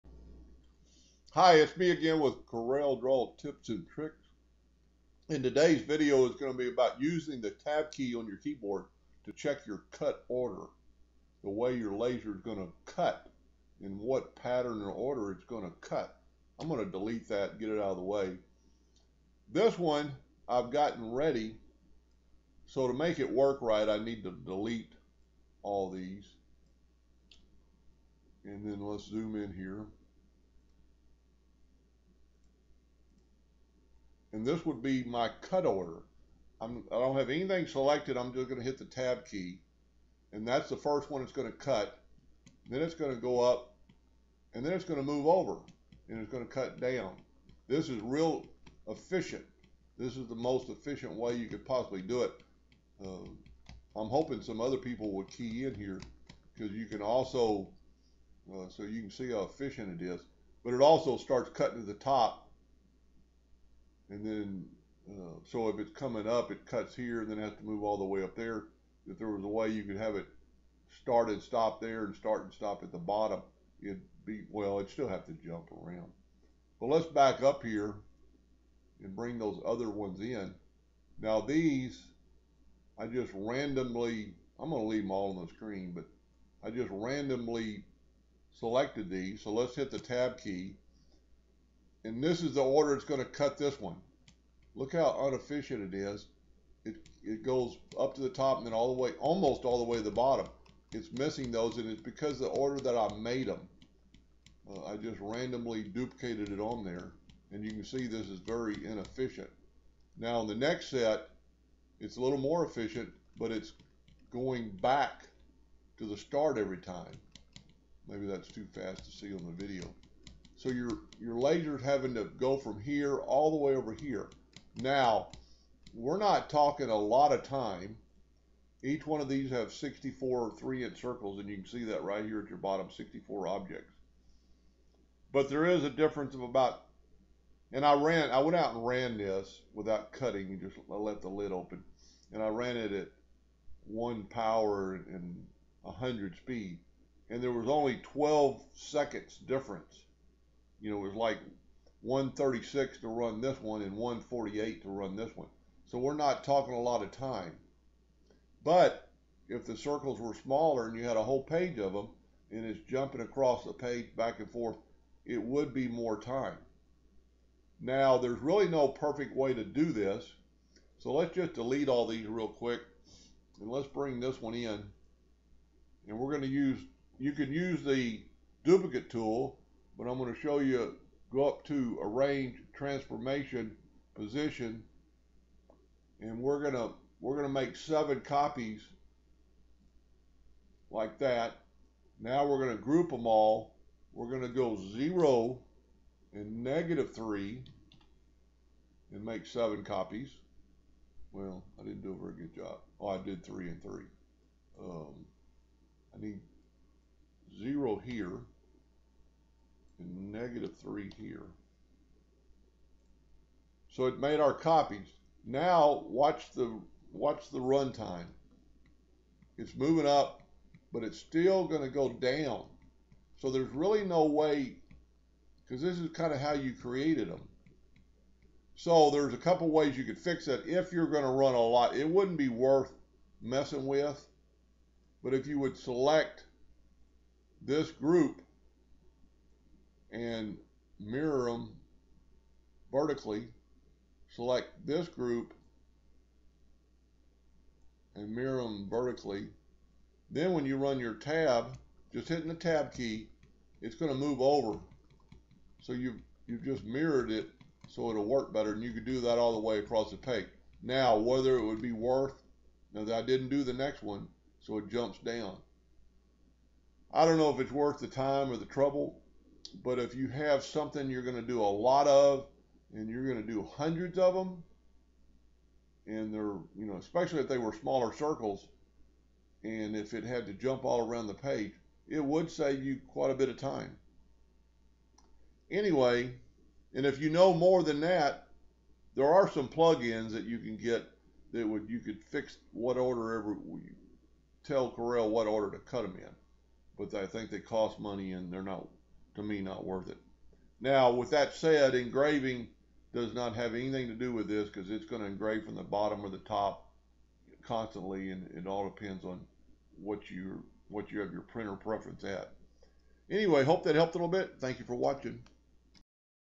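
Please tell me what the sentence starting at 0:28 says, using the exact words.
And then let's zoom in here.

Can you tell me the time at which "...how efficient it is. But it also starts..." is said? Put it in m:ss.
0:59.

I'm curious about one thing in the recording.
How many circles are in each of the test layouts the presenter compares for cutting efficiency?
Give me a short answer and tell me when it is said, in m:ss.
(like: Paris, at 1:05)
64, at 2:09.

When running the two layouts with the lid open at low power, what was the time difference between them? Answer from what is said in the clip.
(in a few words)
12 seconds.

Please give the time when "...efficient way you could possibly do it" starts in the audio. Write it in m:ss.
0:50.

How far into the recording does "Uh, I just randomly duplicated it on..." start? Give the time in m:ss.
1:44.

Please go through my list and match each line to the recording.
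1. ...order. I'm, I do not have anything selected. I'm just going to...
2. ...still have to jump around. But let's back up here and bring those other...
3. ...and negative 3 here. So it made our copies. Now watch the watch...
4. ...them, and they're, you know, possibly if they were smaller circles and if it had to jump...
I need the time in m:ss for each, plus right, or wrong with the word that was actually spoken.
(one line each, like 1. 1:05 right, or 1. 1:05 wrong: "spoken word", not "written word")
1. 0:35 right
2. 1:14 right
3. 3:30 right
4. 4:34 wrong: "especially", not "possibly".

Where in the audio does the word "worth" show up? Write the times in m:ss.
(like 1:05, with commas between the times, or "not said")
3:52, 4:21, 4:27, 4:59.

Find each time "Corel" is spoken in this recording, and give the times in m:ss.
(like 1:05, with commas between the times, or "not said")
0:02, 4:54.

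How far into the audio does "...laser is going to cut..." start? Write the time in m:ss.
0:11.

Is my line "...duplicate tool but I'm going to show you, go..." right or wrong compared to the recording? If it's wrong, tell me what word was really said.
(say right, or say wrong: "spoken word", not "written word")
right.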